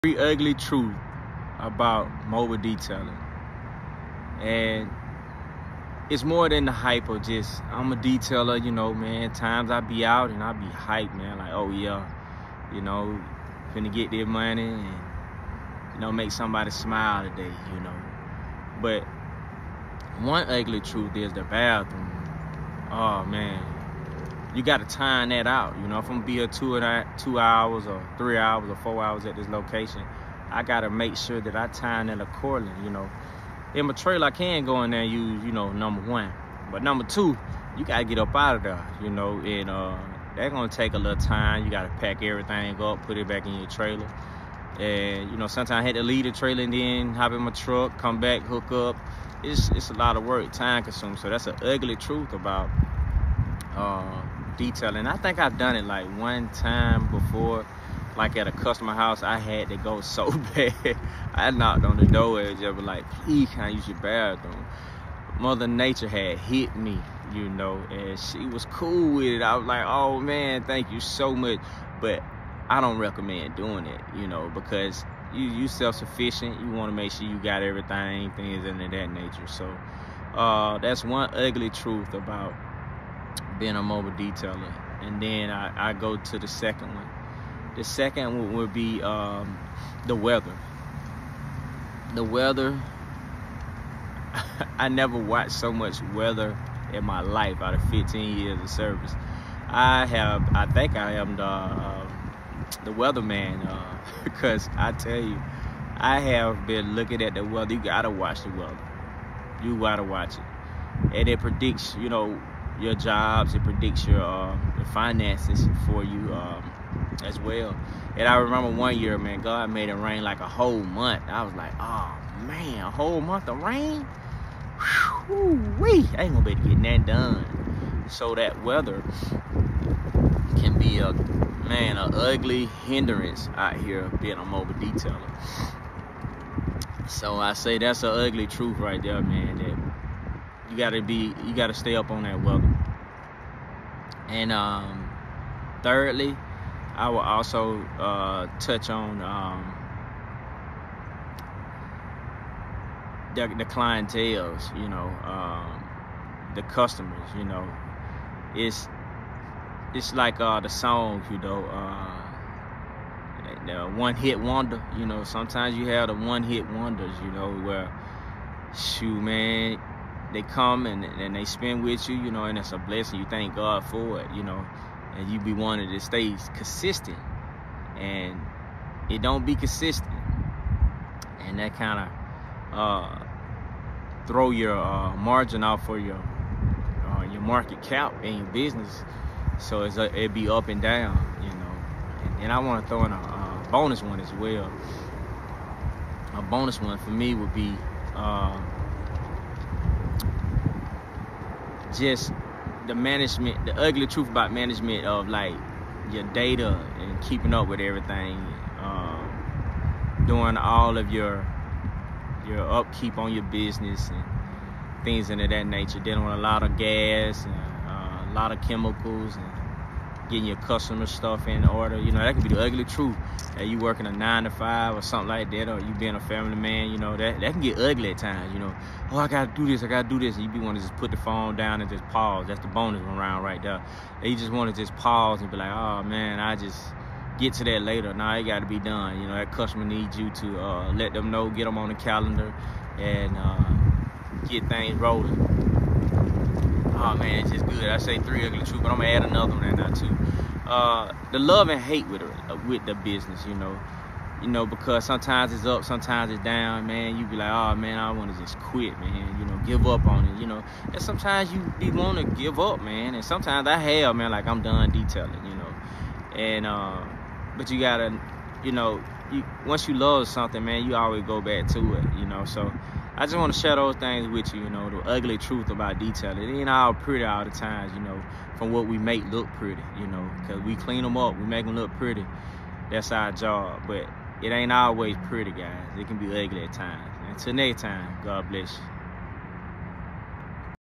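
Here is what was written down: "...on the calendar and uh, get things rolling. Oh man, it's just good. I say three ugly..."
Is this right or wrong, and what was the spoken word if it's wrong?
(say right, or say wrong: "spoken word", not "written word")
right.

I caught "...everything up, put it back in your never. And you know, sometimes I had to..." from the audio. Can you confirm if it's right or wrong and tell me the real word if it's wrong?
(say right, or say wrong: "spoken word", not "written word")
wrong: "trailer", not "never".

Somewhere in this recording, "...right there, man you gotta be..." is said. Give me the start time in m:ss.
2:18.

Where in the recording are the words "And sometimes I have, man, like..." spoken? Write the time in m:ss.
4:23.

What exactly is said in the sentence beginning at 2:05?
Whew-wee, I ain't gonna be able to get that done.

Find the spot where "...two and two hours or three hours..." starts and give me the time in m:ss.
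0:26.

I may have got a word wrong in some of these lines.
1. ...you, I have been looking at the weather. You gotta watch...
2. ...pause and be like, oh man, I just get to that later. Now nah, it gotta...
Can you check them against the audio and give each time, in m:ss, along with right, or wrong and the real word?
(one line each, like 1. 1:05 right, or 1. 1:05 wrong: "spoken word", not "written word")
1. 1:45 right
2. 3:54 right.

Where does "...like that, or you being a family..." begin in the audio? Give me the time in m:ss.
3:45.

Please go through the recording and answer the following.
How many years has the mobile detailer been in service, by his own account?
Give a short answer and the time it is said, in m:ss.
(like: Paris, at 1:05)
15, at 1:37.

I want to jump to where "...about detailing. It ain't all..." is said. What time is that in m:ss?
4:35.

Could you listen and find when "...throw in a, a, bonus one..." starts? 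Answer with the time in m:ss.
3:12.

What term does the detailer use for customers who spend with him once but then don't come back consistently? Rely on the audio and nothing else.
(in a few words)
one hit wonders.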